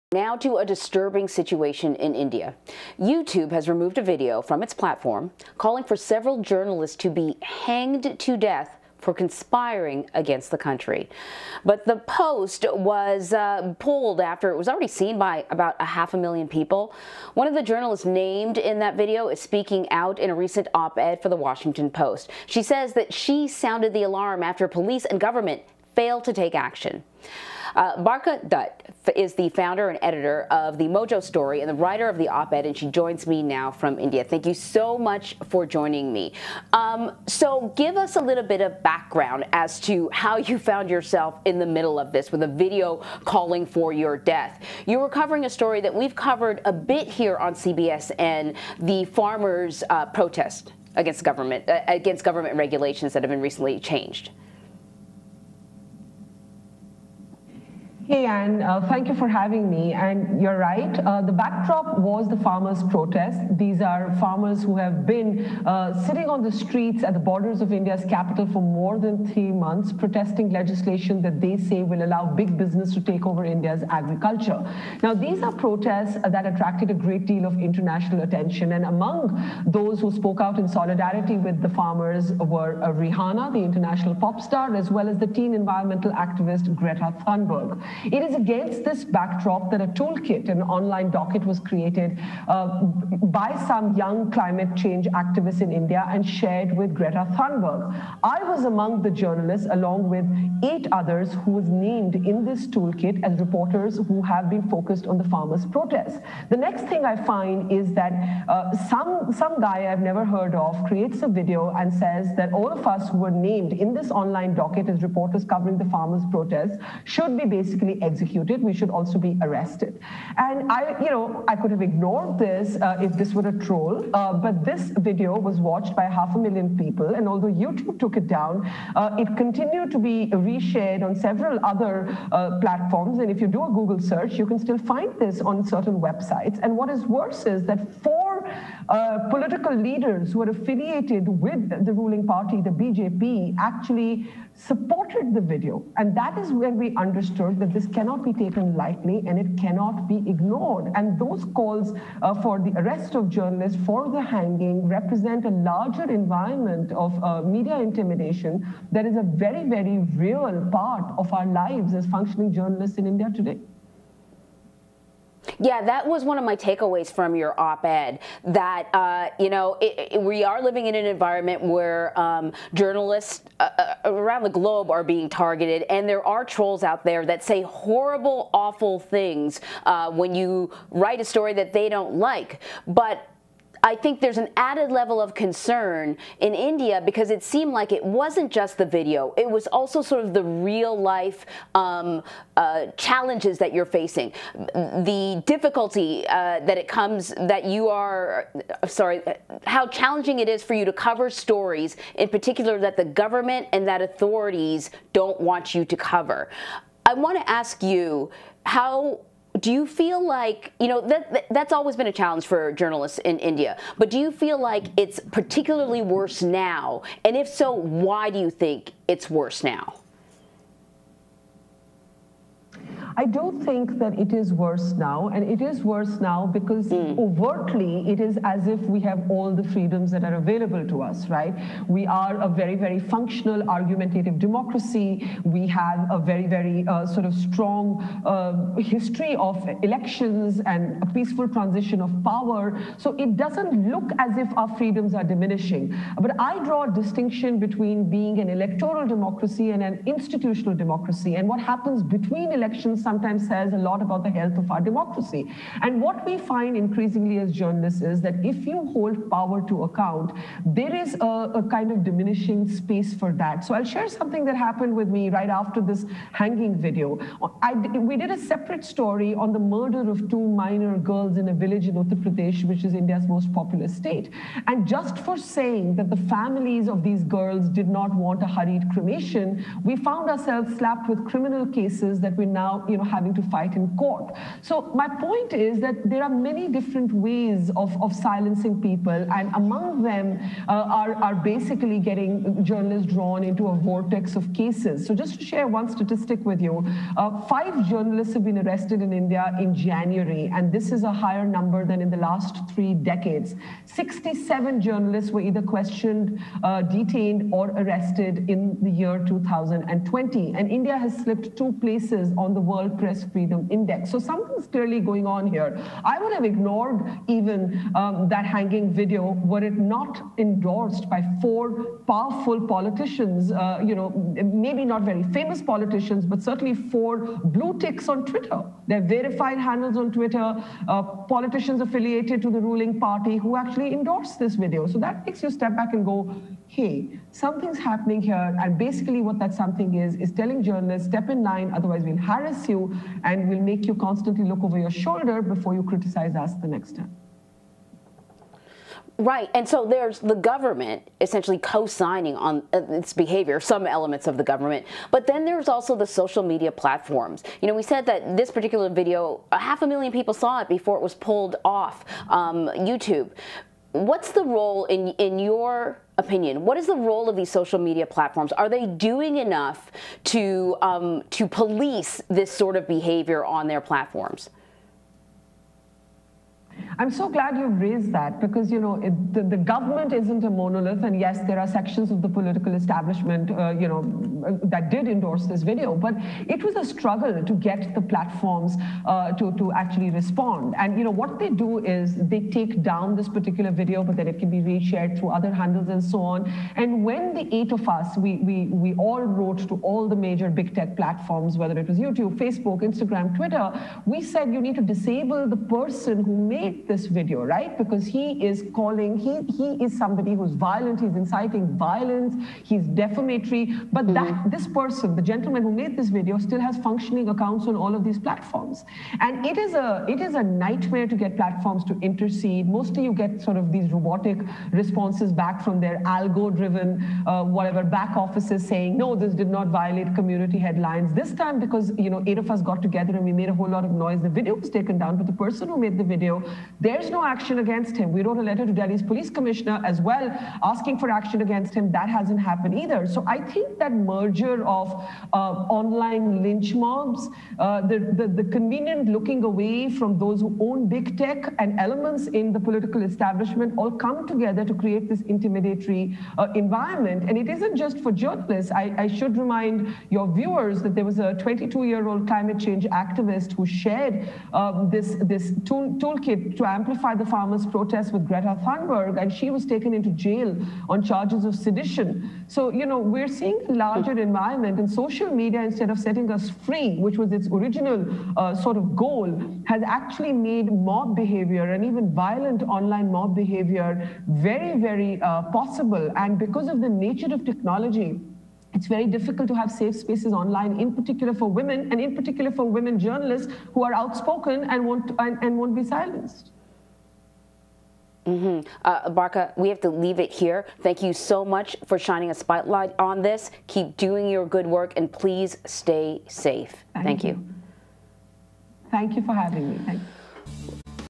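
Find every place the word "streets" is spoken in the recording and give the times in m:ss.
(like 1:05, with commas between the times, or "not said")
1:06.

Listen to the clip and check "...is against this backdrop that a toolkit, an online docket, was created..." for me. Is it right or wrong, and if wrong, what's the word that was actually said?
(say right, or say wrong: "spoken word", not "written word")
right.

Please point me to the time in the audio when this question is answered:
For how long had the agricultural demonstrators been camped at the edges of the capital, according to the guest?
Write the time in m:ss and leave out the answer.
1:08.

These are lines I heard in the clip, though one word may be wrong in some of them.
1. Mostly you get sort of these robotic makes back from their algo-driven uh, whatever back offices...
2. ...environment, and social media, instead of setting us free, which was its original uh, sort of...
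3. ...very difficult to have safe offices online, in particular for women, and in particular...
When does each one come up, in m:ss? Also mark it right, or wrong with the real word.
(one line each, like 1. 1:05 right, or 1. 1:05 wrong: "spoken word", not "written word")
1. 7:02 wrong: "responses", not "makes"
2. 7:54 right
3. 8:08 wrong: "spaces", not "offices".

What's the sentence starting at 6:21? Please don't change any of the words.
And yes, there are sections of the political establishment, uh, you know, that did endorse this video.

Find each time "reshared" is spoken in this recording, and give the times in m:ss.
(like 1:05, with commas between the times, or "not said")
2:10, 6:34.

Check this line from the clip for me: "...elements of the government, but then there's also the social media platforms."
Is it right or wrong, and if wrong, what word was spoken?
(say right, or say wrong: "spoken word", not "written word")
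right.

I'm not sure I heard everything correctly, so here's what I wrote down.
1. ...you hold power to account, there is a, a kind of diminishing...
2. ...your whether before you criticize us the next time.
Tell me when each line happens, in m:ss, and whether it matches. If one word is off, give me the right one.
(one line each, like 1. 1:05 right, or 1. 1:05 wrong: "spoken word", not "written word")
1. 4:18 right
2. 5:44 wrong: "shoulder", not "whether".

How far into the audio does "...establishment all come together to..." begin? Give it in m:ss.
7:33.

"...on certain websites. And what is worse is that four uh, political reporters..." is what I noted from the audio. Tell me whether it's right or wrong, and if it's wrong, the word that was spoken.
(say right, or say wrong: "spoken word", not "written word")
wrong: "leaders", not "reporters".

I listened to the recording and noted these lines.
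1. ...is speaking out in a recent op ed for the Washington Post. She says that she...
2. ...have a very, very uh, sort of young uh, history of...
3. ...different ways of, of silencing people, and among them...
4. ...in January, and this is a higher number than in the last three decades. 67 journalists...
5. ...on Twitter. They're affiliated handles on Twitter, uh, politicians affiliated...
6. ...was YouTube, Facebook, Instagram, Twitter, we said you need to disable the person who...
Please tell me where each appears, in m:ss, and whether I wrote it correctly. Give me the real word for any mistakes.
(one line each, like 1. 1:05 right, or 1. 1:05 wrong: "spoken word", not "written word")
1. 0:19 right
2. 3:55 wrong: "strong", not "young"
3. 4:46 right
4. 4:59 right
5. 5:28 wrong: "verified", not "affiliated"
6. 6:41 right.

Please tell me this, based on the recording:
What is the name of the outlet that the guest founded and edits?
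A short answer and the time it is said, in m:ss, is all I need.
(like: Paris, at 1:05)
the Mojo Story, at 0:30.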